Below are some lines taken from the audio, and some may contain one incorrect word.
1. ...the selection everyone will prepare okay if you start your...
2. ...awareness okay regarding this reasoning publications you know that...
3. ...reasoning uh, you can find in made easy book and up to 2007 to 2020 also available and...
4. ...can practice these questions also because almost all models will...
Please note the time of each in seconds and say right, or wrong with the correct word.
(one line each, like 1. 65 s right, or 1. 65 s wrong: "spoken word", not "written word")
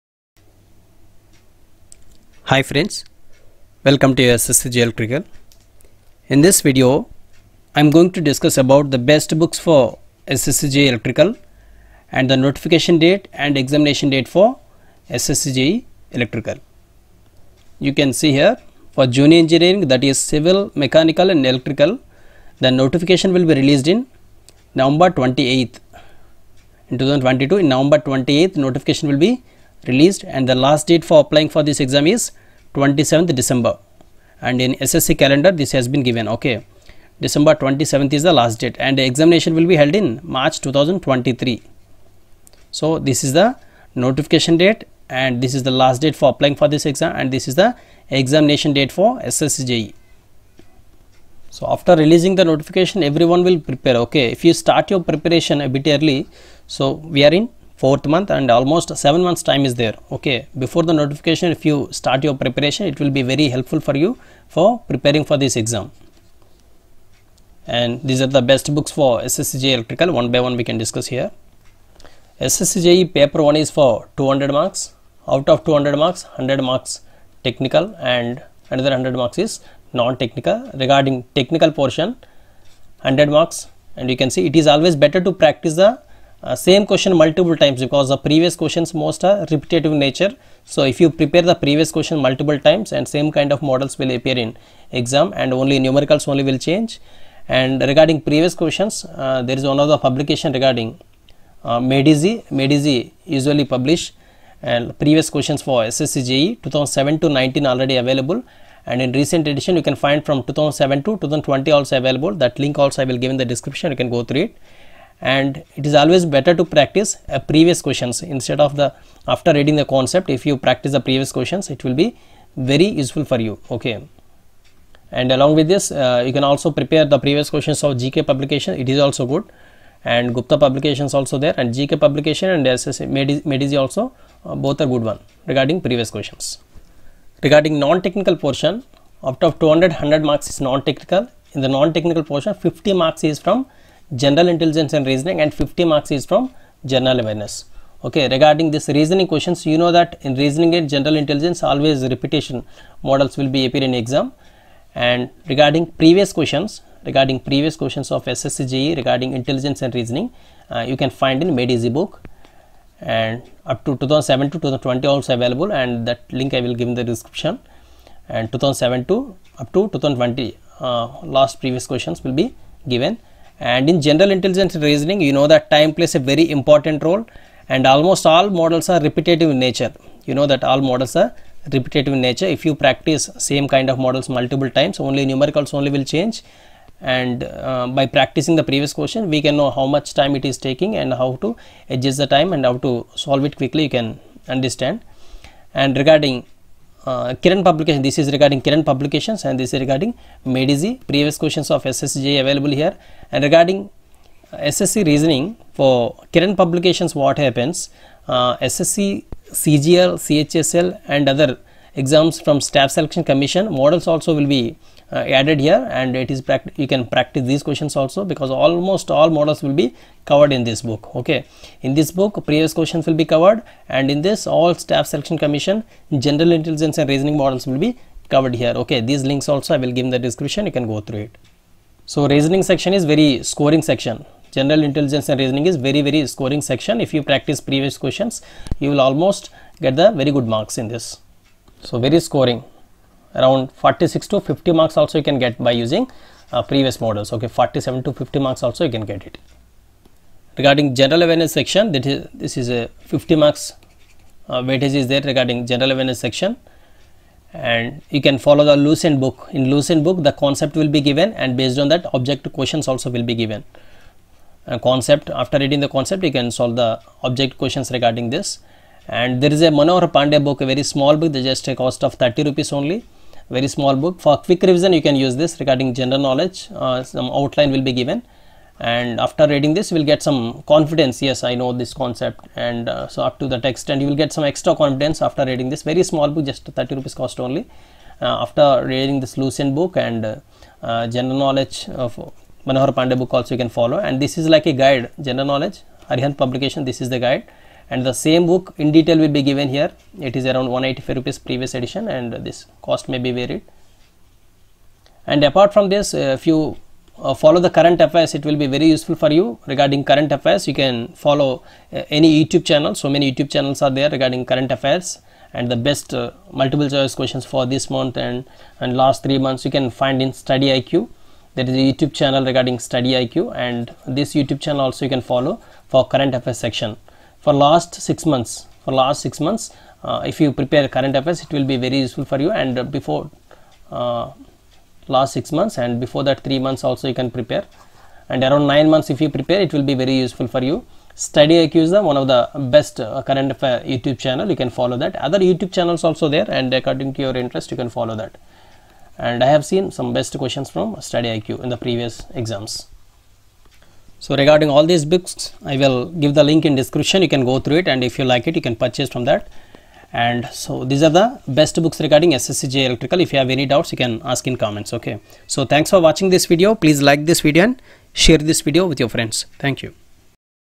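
1. 52 s wrong: "notification", not "selection"
2. 147 s wrong: "questions", not "publications"
3. 159 s right
4. 216 s right.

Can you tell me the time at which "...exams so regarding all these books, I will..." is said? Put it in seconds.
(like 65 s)
352 s.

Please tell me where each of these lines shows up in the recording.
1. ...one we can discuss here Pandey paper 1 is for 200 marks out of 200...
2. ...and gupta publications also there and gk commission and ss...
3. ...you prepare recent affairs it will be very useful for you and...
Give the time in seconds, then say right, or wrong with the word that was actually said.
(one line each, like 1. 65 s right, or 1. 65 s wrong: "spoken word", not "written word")
1. 70 s wrong: "SSCJE", not "Pandey"
2. 130 s wrong: "publication", not "commission"
3. 330 s wrong: "current", not "recent".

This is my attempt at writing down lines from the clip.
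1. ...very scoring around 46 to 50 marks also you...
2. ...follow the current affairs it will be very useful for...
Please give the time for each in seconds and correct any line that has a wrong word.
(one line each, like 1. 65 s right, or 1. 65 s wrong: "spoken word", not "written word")
1. 241 s right
2. 307 s right.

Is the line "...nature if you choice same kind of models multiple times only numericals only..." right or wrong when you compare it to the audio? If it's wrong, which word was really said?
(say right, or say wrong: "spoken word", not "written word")
wrong: "practice", not "choice".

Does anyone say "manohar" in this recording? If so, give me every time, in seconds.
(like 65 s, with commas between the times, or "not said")
269 s, 292 s.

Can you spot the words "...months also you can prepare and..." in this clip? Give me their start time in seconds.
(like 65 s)
336 s.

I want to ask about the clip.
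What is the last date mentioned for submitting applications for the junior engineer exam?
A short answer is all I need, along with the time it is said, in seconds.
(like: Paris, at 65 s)
December 27, at 32 s.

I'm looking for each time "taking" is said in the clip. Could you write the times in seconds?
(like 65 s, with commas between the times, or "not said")
190 s.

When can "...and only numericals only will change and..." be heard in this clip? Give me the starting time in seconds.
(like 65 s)
95 s.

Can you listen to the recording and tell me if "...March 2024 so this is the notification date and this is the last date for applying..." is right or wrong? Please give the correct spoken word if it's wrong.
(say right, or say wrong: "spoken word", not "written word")
wrong: "2023", not "2024".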